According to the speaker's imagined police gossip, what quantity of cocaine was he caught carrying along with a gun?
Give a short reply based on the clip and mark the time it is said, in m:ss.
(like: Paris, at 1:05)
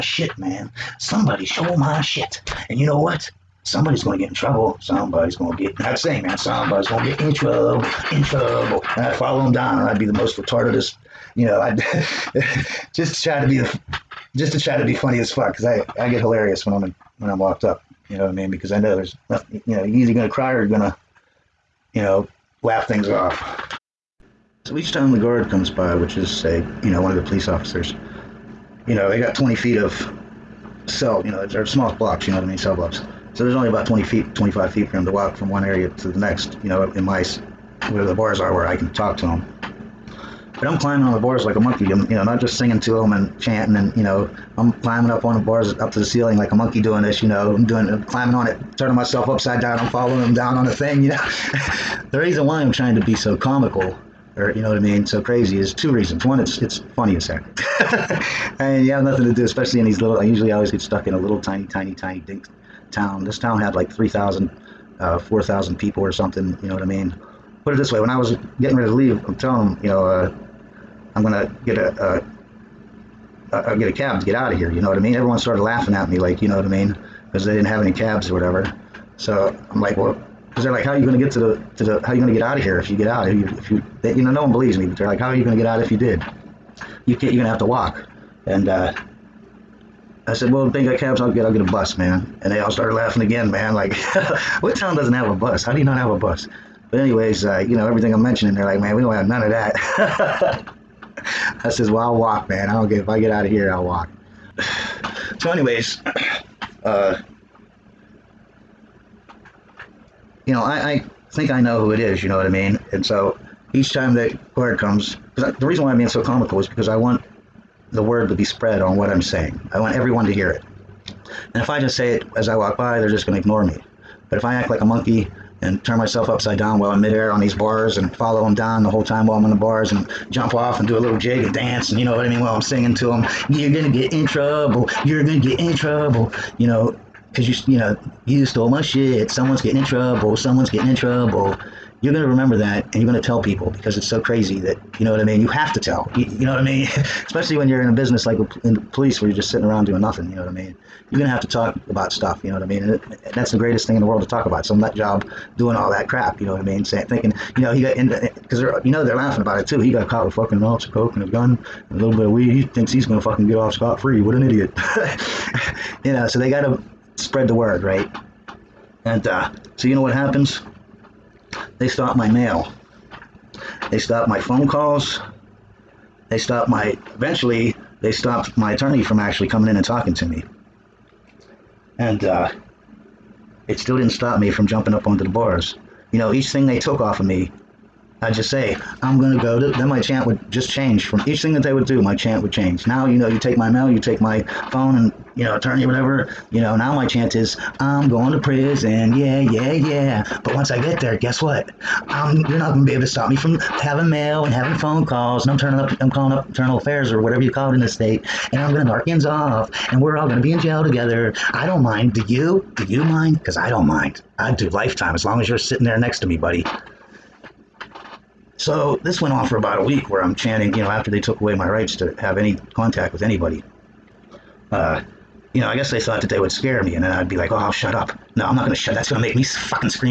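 An ounce, at 2:40.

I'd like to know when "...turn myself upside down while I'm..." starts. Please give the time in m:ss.
2:05.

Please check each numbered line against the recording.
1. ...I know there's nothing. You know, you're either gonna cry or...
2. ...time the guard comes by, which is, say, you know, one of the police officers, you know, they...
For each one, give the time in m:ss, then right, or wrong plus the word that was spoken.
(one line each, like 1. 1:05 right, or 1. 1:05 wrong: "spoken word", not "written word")
1. 0:18 right
2. 0:24 right.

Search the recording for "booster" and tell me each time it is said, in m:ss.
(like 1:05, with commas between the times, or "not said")
not said.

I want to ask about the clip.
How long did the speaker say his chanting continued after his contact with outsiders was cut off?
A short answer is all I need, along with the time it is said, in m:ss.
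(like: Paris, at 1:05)
About a week, at 3:39.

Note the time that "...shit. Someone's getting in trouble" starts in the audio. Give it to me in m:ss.
2:18.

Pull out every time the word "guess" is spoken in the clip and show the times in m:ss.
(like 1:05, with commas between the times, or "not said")
3:21, 3:45.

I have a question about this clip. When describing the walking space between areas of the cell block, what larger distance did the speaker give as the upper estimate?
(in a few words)
25 feet.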